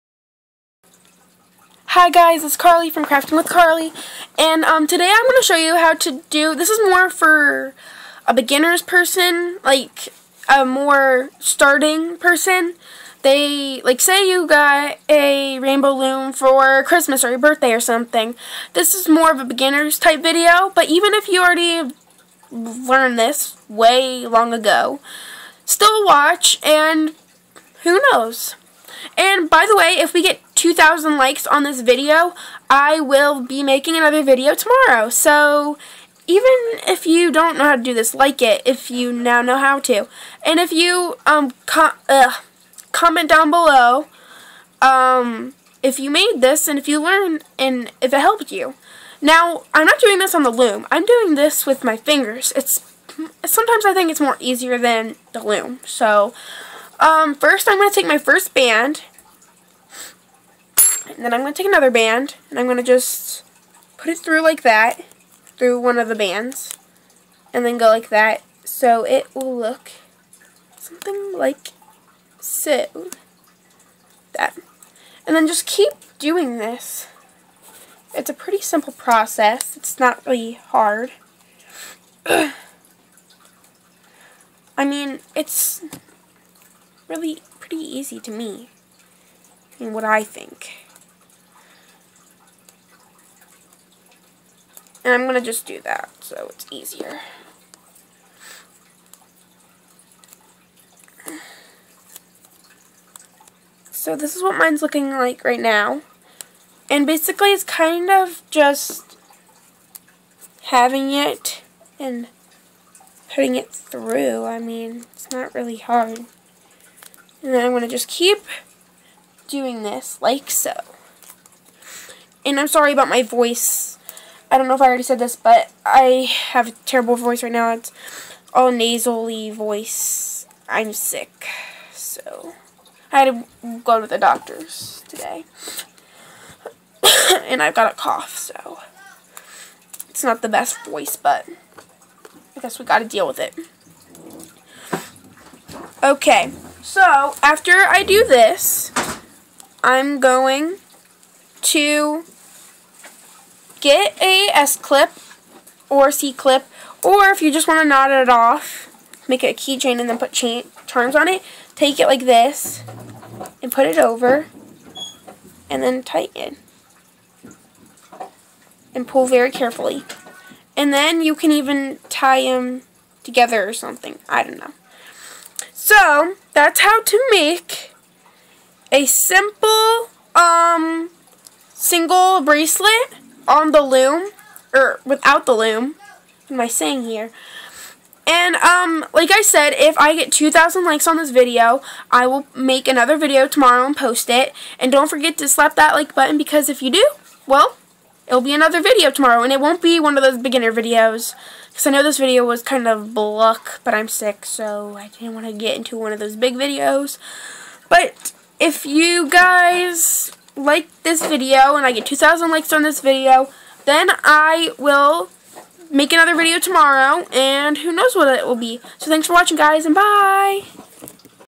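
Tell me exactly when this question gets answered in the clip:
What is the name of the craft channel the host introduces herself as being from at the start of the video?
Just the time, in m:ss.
0:03.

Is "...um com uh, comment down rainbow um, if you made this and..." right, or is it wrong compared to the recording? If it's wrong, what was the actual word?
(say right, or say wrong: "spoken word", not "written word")
wrong: "below", not "rainbow".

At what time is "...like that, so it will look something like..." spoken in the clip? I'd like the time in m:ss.
1:07.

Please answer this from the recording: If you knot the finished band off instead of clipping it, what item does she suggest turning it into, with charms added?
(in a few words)
A keychain.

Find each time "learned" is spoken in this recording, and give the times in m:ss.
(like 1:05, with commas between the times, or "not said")
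0:22, 0:47.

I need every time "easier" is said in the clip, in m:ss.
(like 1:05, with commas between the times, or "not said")
0:54, 1:36.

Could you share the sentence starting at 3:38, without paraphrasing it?
So thanks for watching, guys, and bye!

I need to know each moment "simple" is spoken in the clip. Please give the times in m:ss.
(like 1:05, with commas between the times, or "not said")
1:18, 2:59.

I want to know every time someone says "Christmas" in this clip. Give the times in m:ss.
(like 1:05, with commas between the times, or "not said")
0:16.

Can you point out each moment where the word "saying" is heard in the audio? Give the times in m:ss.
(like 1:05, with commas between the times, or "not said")
3:06.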